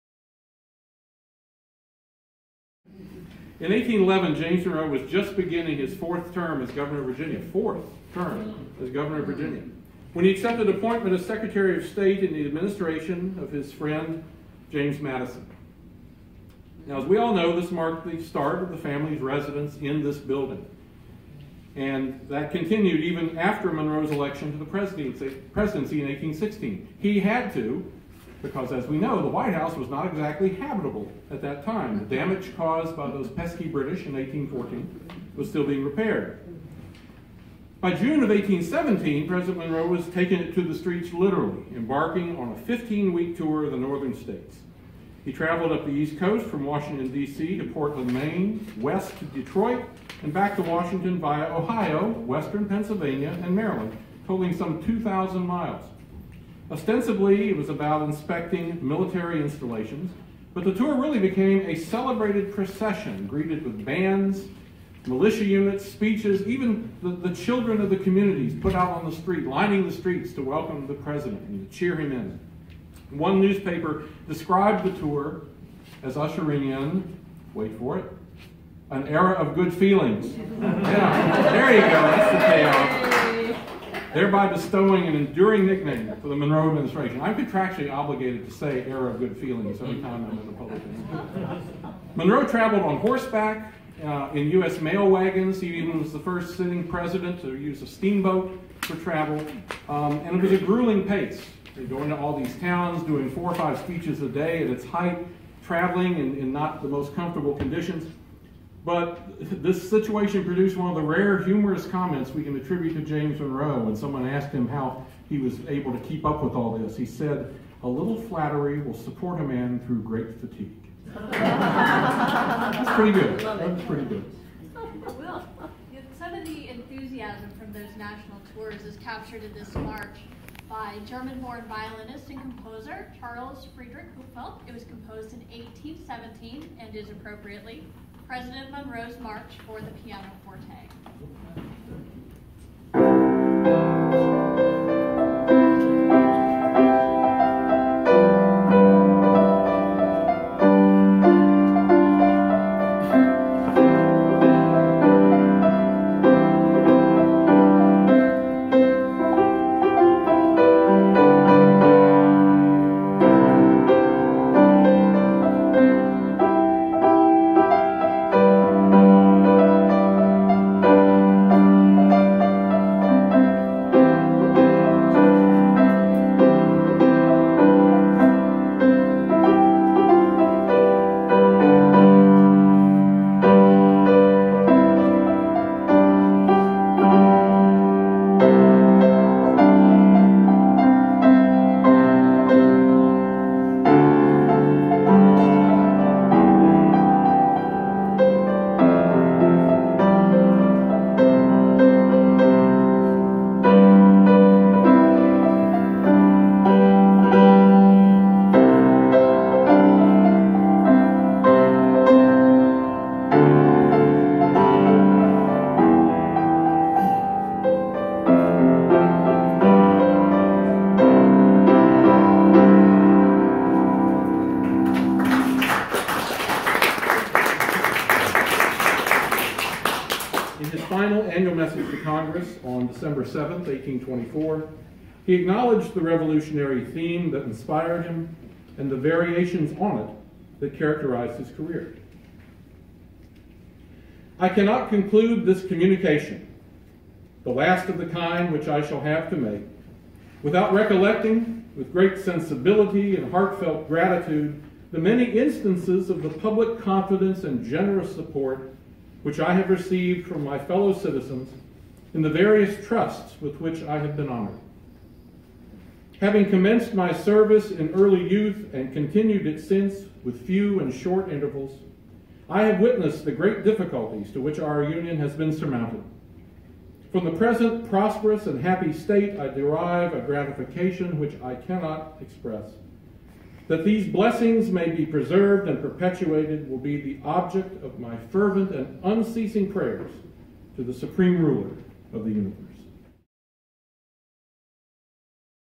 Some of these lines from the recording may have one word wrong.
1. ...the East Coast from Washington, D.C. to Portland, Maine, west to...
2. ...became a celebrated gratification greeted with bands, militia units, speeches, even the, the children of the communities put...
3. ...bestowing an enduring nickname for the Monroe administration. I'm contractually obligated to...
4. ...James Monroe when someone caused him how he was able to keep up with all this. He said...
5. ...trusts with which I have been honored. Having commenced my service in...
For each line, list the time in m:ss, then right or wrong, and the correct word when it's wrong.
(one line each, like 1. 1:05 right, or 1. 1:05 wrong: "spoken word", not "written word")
1. 0:45 right
2. 1:01 wrong: "procession", not "gratification"
3. 1:24 right
4. 1:53 wrong: "asked", not "caused"
5. 4:22 right.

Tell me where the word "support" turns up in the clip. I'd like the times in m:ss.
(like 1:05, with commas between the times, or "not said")
1:58, 4:18.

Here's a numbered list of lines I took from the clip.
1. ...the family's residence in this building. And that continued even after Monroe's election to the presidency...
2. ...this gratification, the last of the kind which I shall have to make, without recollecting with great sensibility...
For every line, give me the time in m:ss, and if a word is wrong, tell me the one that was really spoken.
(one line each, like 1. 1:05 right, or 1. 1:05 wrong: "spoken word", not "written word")
1. 0:18 right
2. 4:05 wrong: "communication", not "gratification".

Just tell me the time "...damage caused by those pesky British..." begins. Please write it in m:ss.
0:32.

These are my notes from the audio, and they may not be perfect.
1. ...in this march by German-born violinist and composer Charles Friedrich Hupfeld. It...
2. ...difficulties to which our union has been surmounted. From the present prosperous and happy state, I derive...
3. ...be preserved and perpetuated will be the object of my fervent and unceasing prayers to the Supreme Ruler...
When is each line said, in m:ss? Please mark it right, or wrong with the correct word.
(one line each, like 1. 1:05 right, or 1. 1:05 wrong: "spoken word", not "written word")
1. 2:09 right
2. 4:33 right
3. 4:44 right.